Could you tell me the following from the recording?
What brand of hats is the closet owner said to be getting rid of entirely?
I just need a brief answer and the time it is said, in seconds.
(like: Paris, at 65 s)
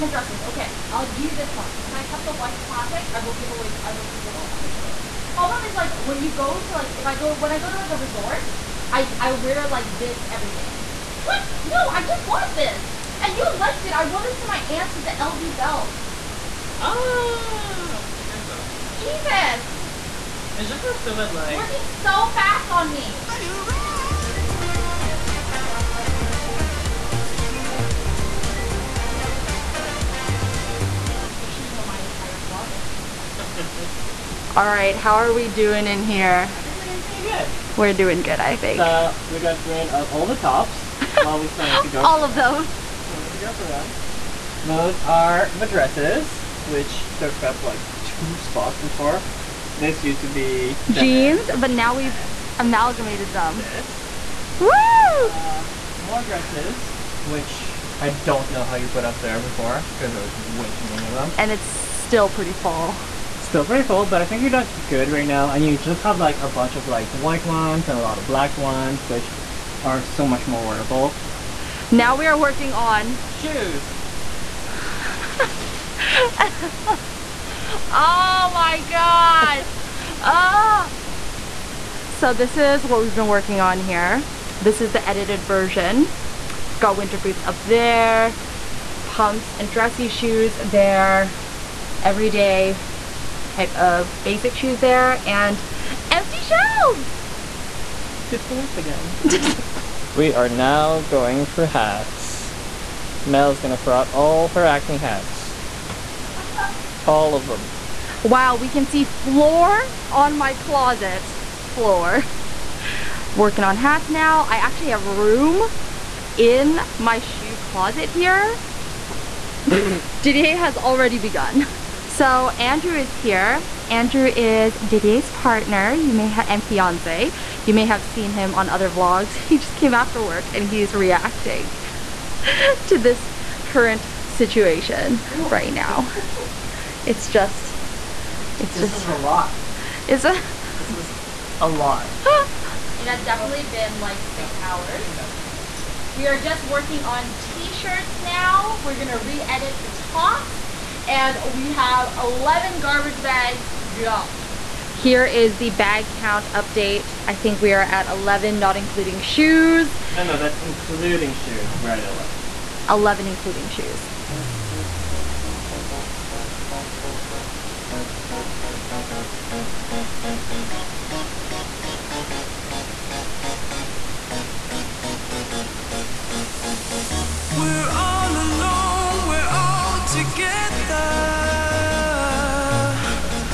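Acne, at 104 s.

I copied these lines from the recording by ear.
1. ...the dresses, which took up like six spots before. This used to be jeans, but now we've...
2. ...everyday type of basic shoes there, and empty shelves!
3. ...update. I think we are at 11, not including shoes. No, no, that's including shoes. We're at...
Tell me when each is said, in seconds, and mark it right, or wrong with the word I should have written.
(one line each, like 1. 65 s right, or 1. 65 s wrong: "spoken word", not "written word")
1. 45 s wrong: "two", not "six"
2. 92 s right
3. 156 s right.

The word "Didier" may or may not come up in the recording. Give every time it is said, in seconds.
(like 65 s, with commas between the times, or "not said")
120 s, 124 s.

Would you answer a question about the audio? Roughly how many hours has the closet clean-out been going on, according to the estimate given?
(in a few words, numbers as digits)
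6.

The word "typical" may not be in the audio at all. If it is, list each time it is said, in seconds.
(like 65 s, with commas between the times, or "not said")
not said.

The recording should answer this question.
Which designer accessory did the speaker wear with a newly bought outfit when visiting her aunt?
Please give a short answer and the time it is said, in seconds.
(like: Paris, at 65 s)
LV belt, at 15 s.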